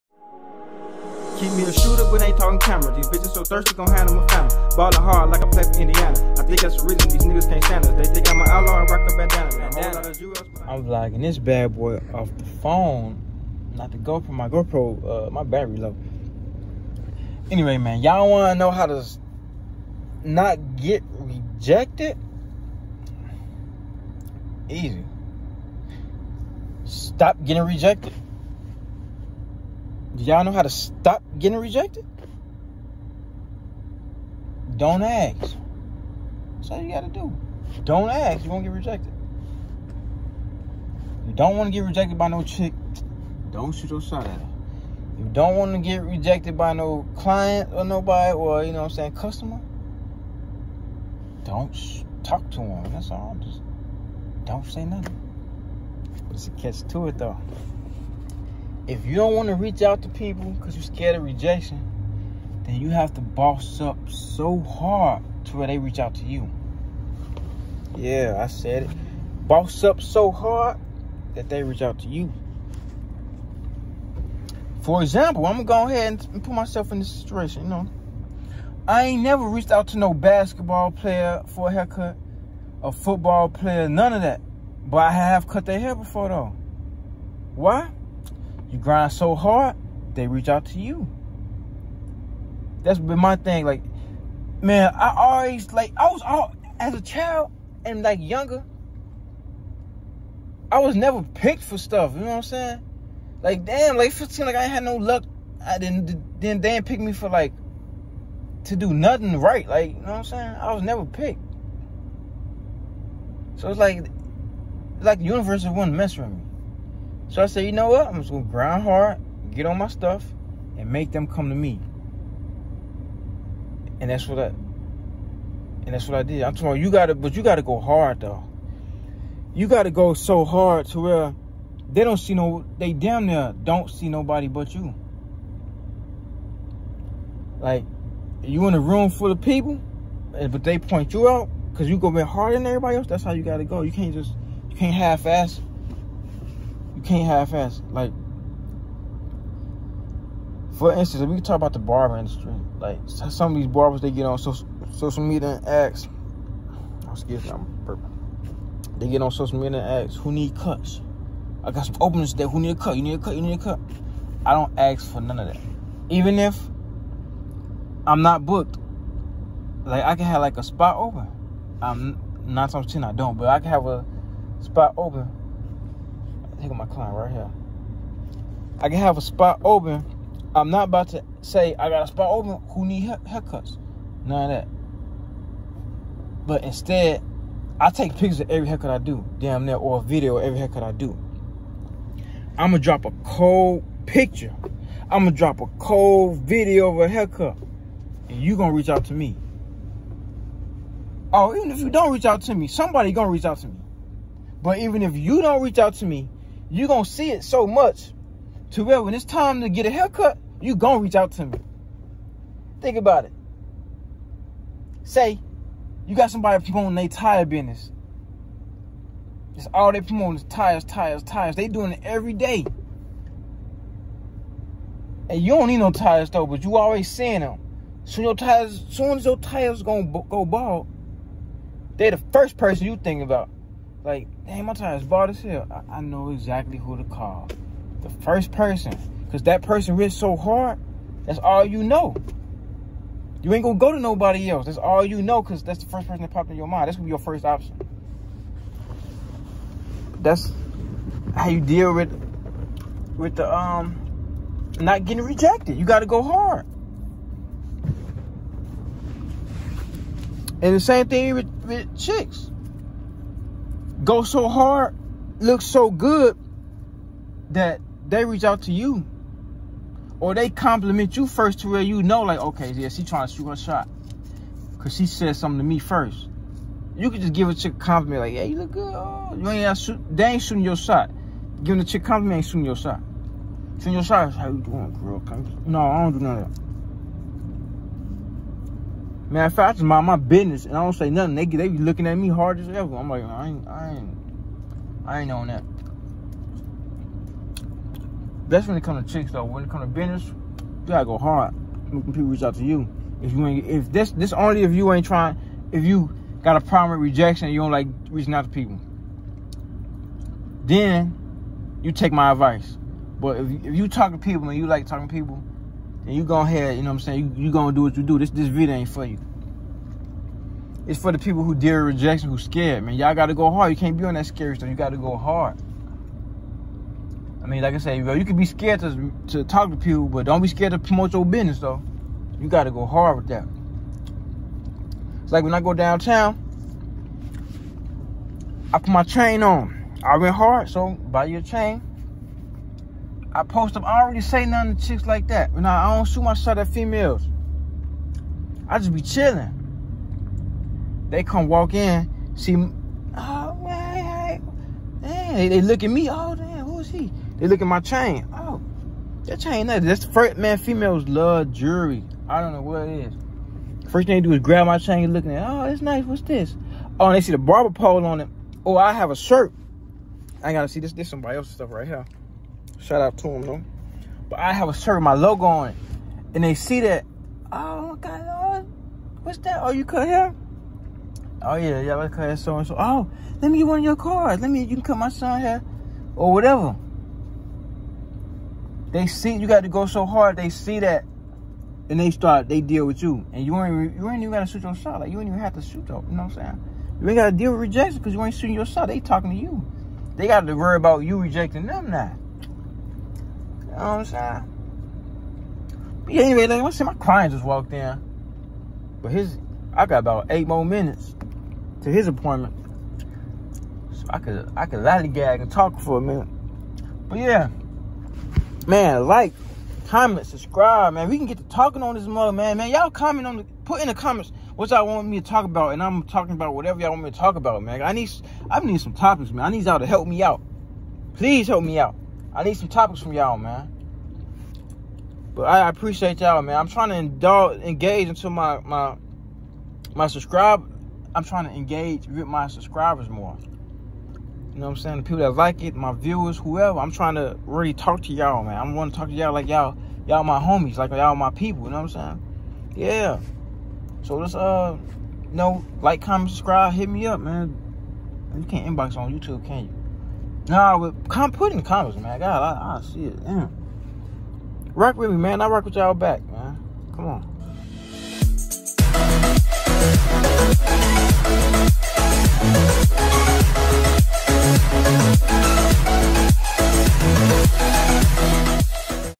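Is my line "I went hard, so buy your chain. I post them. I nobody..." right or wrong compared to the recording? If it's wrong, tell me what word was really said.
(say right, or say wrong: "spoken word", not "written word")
wrong: "already", not "nobody".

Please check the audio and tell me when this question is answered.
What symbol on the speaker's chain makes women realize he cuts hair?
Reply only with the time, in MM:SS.
06:07.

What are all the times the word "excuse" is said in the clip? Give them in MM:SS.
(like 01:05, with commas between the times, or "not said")
02:37.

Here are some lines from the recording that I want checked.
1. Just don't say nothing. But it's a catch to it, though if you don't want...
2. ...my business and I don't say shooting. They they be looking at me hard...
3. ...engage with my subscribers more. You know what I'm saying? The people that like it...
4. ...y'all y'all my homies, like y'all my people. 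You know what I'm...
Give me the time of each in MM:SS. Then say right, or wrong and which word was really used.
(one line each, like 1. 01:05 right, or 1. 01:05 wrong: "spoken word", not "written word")
1. 00:53 right
2. 04:50 wrong: "nothing", not "shooting"
3. 07:21 right
4. 07:29 right.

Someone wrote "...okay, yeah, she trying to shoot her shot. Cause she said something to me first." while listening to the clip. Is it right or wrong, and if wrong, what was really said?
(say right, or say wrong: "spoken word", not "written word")
right.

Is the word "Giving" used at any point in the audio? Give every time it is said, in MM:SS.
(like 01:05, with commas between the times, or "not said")
04:41.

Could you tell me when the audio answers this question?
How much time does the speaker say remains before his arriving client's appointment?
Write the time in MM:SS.
06:50.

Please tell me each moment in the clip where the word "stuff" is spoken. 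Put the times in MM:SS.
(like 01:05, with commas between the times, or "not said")
01:41, 01:59, 05:24, 06:11.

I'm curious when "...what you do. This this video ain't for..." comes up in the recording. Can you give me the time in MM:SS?
05:17.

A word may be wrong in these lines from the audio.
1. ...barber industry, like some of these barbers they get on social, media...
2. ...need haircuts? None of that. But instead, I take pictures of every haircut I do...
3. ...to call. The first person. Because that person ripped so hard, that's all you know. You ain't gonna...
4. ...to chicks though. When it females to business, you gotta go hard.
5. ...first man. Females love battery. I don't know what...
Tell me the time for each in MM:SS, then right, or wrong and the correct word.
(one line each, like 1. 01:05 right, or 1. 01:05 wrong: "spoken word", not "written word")
1. 02:31 right
2. 03:02 right
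3. 03:56 right
4. 04:59 wrong: "comes", not "females"
5. 06:00 wrong: "jewelry", not "battery".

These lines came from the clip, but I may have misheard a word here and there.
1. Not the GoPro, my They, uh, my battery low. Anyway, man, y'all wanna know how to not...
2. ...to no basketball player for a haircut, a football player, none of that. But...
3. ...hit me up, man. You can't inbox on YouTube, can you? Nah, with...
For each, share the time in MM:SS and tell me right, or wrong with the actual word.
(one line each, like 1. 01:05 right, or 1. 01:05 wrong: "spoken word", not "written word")
1. 00:13 wrong: "GoPro", not "They"
2. 01:19 right
3. 07:36 right.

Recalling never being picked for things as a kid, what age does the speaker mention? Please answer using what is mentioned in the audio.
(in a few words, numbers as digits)
15.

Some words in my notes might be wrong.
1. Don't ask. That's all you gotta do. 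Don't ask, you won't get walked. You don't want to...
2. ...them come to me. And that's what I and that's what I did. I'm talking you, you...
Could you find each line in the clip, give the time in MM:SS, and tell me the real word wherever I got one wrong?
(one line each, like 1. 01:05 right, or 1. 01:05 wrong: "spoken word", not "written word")
1. 00:34 wrong: "rejected", not "walked"
2. 02:01 right.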